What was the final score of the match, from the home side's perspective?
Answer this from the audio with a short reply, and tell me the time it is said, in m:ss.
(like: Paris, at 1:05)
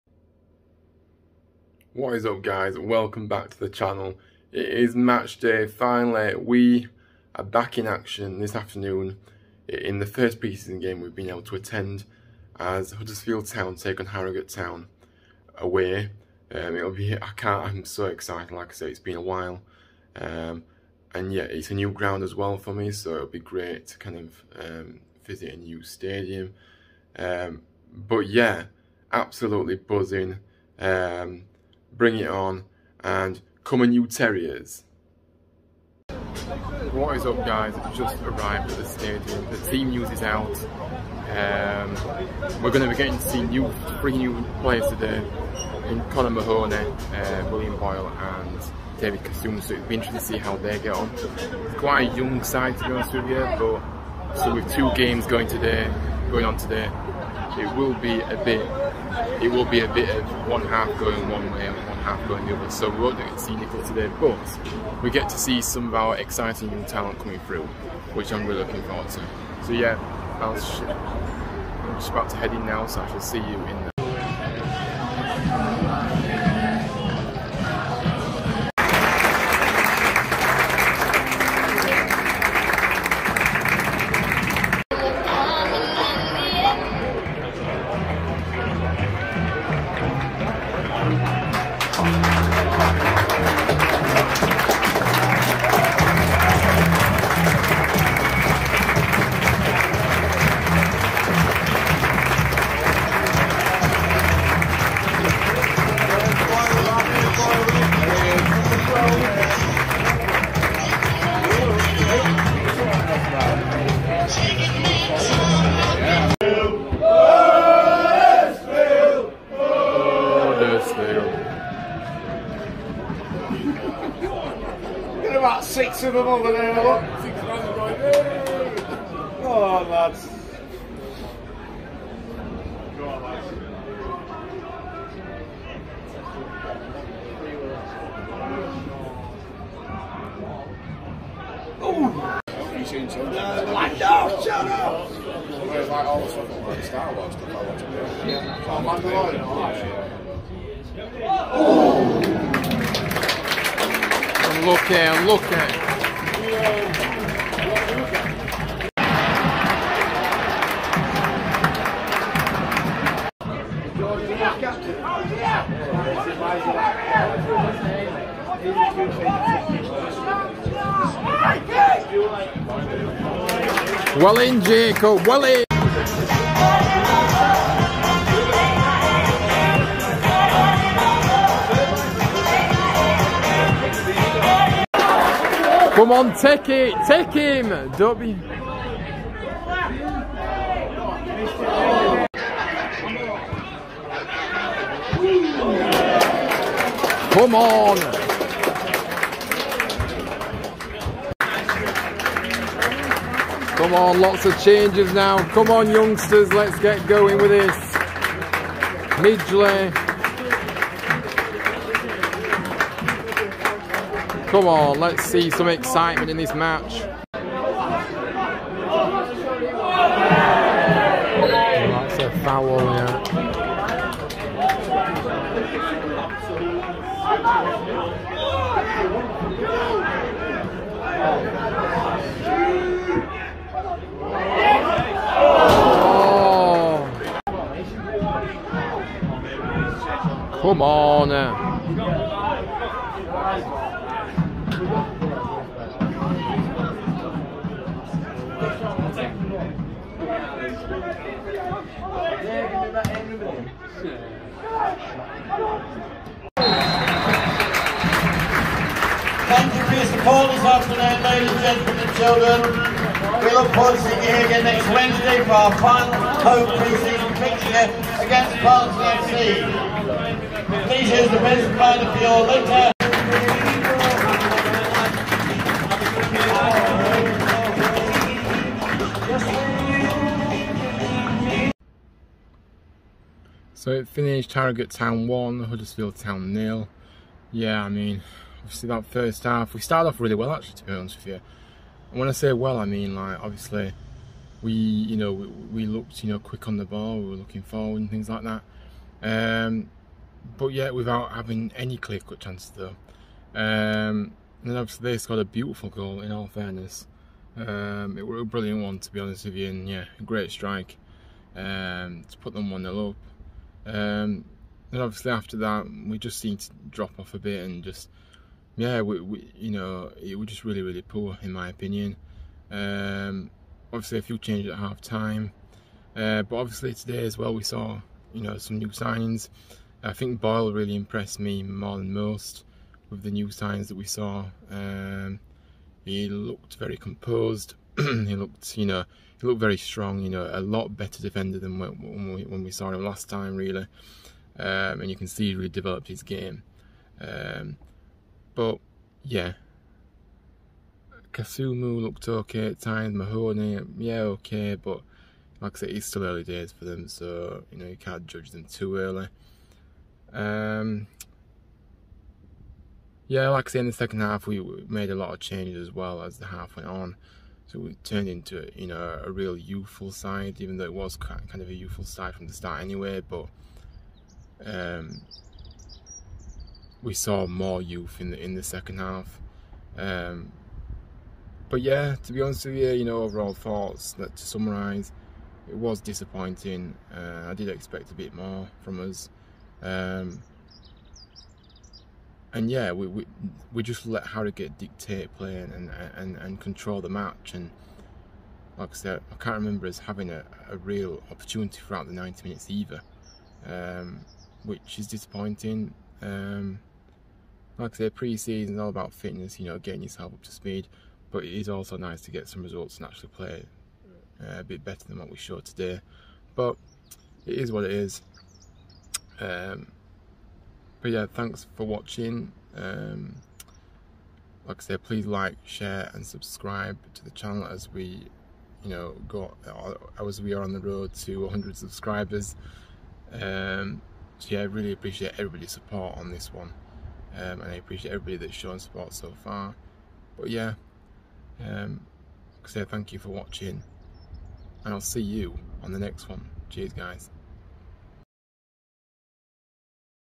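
1-0, at 4:44.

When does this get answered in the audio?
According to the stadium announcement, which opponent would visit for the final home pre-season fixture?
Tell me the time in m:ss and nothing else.
4:28.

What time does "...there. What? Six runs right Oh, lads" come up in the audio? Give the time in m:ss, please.
2:06.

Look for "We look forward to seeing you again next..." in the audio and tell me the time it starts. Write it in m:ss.
4:23.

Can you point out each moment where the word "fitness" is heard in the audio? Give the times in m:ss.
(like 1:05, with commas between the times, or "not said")
6:49.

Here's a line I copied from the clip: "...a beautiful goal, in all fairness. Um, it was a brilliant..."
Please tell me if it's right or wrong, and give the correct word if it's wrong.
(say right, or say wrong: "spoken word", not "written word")
right.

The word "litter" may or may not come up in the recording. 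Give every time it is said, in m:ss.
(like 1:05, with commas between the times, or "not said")
4:32.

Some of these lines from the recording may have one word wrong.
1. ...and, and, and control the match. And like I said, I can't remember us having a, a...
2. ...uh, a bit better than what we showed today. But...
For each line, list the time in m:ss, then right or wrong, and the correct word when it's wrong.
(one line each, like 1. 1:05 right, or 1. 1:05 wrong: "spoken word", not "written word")
1. 6:35 right
2. 6:54 right.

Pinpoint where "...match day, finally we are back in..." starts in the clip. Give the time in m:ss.
0:04.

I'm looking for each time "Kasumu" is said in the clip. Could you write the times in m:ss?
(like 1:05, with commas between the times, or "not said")
0:49, 5:51.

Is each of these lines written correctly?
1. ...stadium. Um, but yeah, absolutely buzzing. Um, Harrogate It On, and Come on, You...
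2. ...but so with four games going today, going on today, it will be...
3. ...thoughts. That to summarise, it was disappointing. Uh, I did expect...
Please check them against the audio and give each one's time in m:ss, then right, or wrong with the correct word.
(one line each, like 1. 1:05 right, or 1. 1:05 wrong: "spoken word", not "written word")
1. 0:25 wrong: "Bring", not "Harrogate"
2. 0:53 wrong: "two", not "four"
3. 6:23 right.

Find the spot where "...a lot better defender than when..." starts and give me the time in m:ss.
5:40.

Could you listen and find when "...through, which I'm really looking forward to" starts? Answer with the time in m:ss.
1:07.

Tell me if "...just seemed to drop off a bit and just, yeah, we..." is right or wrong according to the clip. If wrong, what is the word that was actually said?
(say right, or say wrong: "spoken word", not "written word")
right.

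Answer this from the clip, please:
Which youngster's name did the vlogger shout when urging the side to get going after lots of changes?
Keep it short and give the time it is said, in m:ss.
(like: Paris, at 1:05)
Midgley, at 3:29.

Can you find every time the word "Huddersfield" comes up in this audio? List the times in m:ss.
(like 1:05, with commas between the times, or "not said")
0:12, 4:45.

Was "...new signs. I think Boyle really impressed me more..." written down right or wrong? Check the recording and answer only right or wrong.
right.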